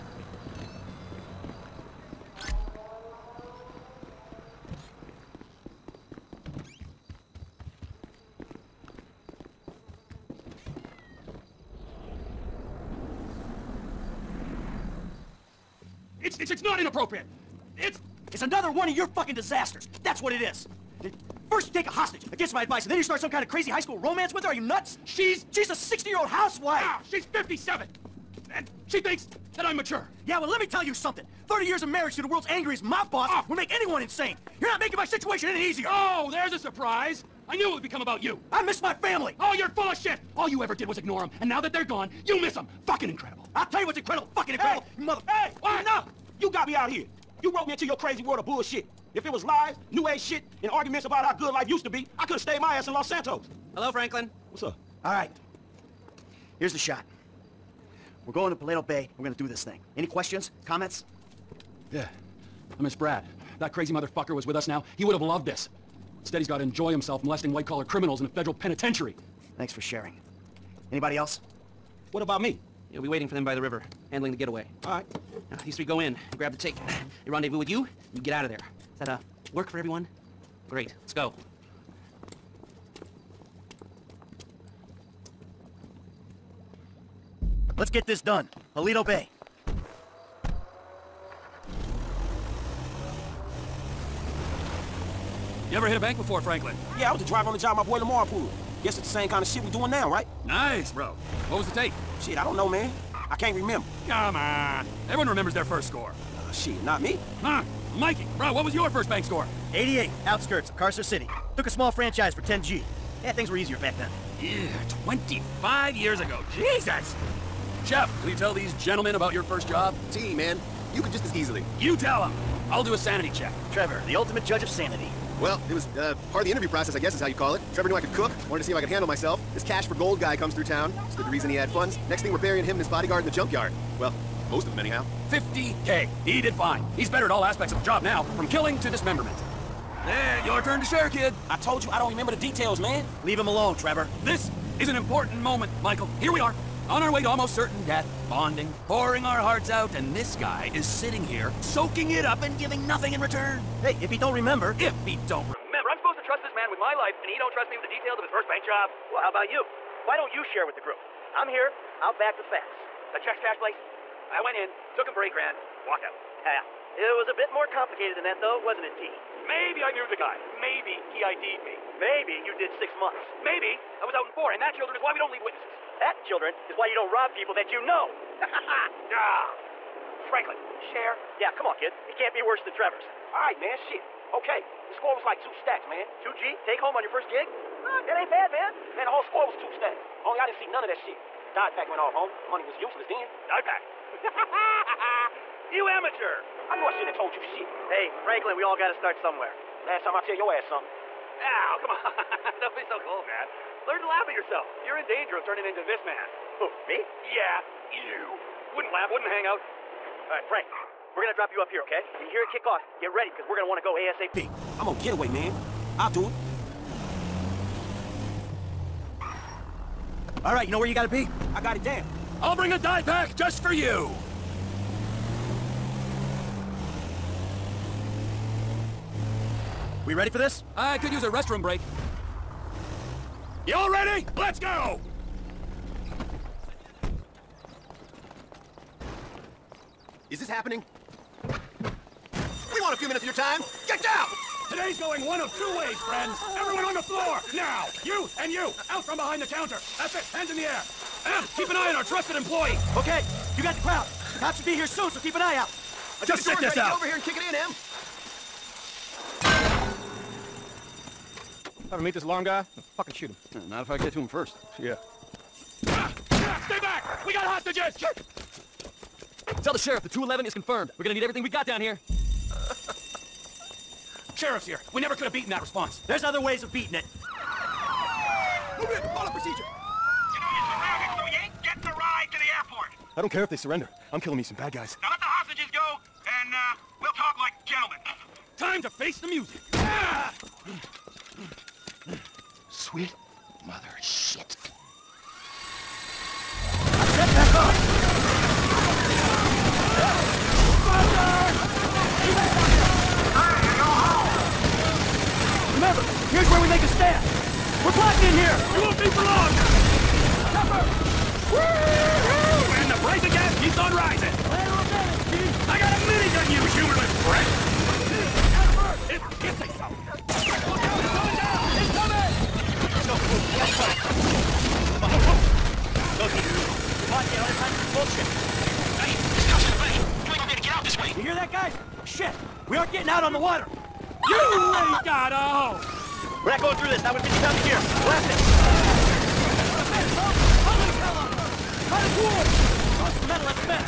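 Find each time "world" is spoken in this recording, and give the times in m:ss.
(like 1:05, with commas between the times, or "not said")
0:32, 0:48.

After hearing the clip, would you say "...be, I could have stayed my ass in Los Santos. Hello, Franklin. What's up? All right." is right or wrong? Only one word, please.
right.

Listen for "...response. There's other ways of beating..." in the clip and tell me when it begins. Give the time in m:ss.
4:35.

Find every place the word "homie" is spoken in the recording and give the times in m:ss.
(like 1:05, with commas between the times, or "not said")
3:12.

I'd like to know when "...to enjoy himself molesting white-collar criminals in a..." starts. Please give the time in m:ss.
1:06.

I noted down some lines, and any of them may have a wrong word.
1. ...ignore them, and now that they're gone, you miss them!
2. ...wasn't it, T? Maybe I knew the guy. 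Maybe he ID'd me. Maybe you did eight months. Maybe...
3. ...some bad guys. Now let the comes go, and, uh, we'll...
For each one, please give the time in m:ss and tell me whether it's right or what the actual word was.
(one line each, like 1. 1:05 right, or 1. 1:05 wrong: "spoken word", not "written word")
1. 0:40 right
2. 2:48 wrong: "six", not "eight"
3. 4:44 wrong: "hostages", not "comes".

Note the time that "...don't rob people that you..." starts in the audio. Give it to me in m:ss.
2:56.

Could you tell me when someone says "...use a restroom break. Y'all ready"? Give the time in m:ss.
3:51.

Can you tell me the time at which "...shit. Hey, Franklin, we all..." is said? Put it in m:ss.
3:17.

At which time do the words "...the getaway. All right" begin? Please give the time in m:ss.
1:14.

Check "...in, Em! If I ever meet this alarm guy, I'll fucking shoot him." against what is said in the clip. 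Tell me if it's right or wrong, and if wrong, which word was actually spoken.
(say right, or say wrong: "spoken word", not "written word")
right.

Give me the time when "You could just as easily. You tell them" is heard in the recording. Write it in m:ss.
2:00.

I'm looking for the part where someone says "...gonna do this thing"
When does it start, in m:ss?
0:59.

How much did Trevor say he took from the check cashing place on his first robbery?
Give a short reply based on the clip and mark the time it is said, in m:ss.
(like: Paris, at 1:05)
8 grand, at 2:45.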